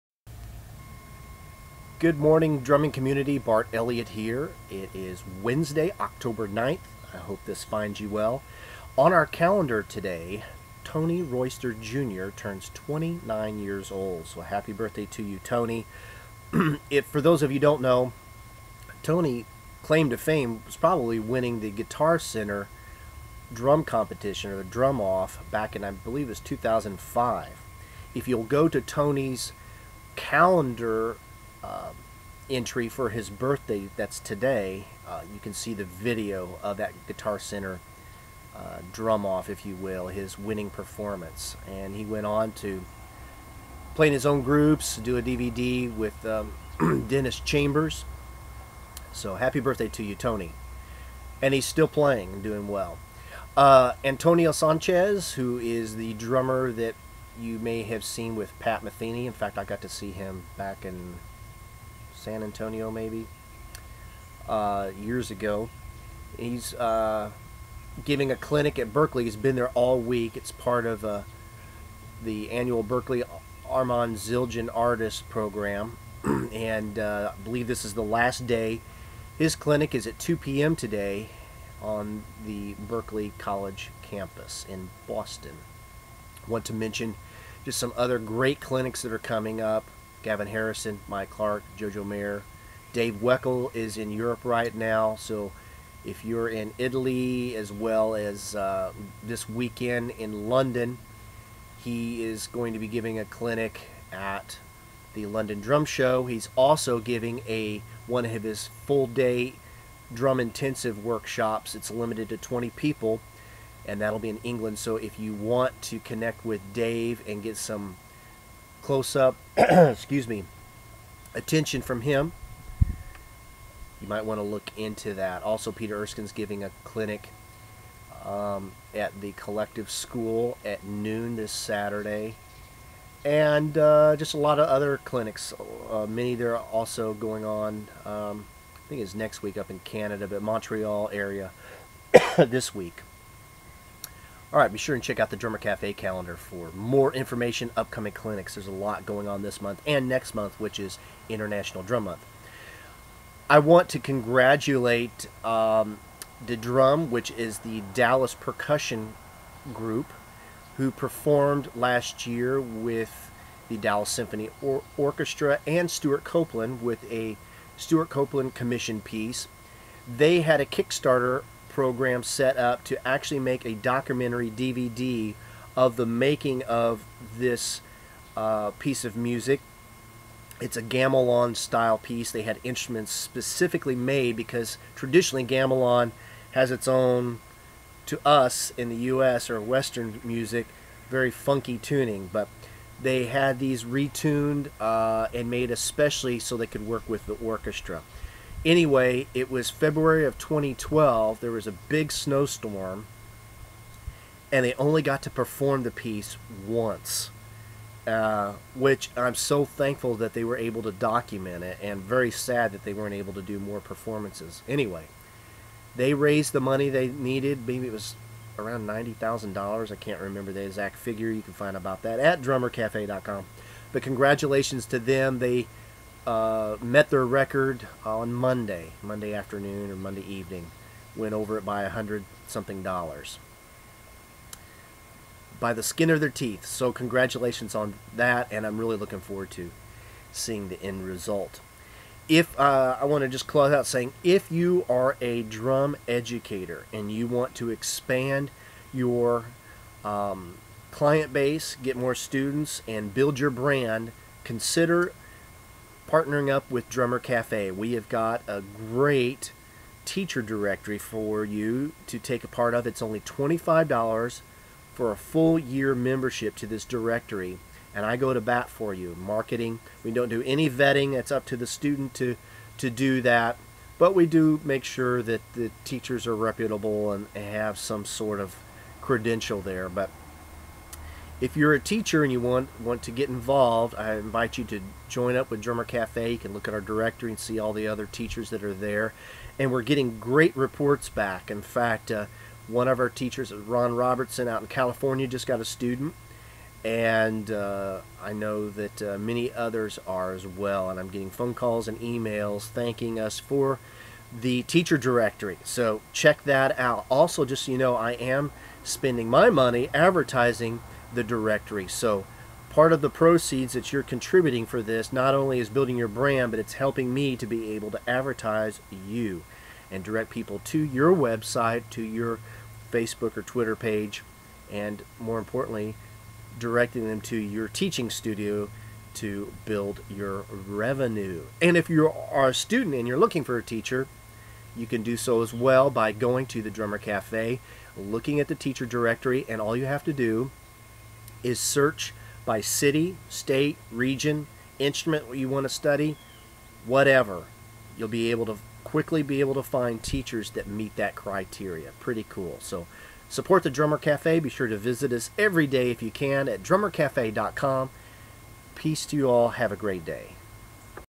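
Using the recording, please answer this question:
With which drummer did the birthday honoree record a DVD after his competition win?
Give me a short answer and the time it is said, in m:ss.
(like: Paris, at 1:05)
Dennis Chambers, at 0:47.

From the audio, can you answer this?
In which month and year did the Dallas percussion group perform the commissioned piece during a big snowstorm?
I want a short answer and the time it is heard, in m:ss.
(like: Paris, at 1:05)
February 2012, at 3:19.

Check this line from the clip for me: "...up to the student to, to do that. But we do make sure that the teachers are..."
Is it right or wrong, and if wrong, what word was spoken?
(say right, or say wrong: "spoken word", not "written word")
right.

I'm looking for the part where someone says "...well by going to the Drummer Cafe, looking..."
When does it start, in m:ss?
5:35.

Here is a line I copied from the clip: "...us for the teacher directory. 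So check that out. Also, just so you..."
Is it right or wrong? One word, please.
right.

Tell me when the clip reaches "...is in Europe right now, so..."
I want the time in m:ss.
1:33.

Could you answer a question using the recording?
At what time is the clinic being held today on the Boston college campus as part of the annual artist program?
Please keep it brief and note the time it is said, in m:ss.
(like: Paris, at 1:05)
2 p.m., at 1:20.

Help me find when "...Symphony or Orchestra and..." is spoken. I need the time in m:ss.
2:44.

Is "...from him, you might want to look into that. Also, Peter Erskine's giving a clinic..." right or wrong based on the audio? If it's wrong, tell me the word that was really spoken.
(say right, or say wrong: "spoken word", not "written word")
right.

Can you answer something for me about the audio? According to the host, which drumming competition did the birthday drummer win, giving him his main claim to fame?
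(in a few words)
Guitar Center drum competition.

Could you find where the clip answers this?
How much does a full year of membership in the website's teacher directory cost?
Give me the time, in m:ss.
4:23.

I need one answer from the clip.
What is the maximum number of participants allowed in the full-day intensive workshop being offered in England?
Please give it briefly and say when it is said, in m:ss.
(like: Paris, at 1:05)
20, at 1:52.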